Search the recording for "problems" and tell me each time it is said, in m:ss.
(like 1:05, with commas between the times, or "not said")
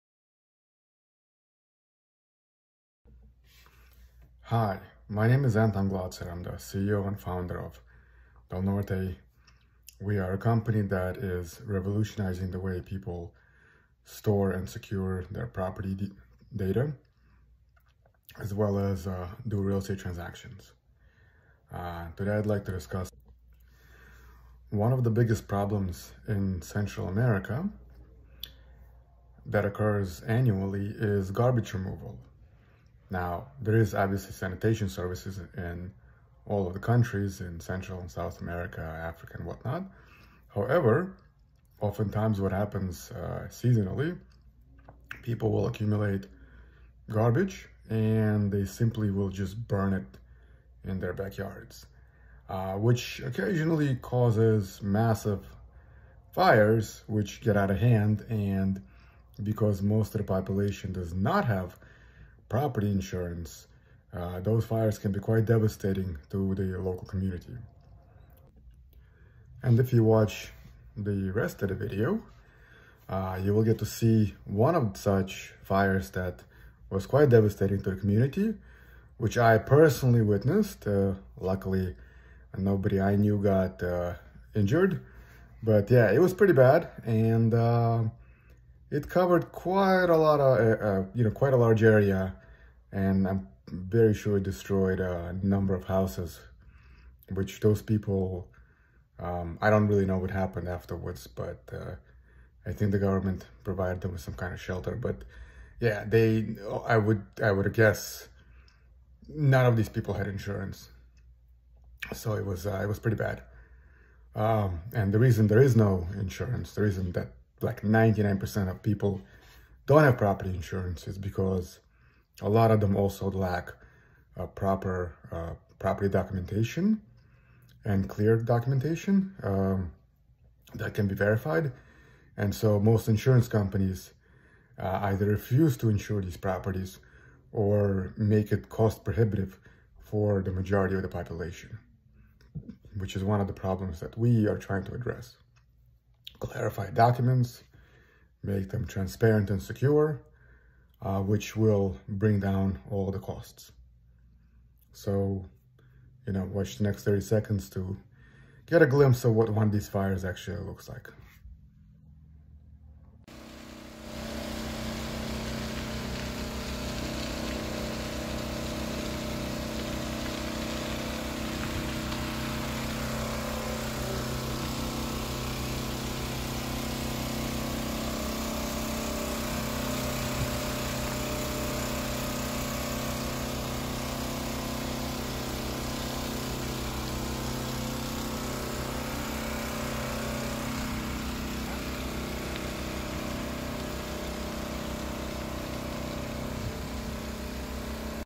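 0:25, 2:23.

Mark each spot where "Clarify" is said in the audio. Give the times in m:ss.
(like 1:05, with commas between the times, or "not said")
2:26.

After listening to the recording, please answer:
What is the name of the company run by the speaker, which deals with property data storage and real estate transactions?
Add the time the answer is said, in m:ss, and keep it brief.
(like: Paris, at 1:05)
Del Norte, at 0:08.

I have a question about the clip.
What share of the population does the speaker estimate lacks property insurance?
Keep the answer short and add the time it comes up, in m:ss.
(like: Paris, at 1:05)
99%, at 1:57.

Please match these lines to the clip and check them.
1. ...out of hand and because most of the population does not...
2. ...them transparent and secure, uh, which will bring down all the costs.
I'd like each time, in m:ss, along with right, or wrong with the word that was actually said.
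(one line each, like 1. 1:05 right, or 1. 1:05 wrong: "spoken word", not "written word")
1. 0:57 right
2. 2:28 right.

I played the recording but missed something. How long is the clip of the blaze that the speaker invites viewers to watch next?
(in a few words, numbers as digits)
30 seconds.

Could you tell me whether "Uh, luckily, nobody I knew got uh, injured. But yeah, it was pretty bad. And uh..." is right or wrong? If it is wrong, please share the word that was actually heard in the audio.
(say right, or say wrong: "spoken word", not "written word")
right.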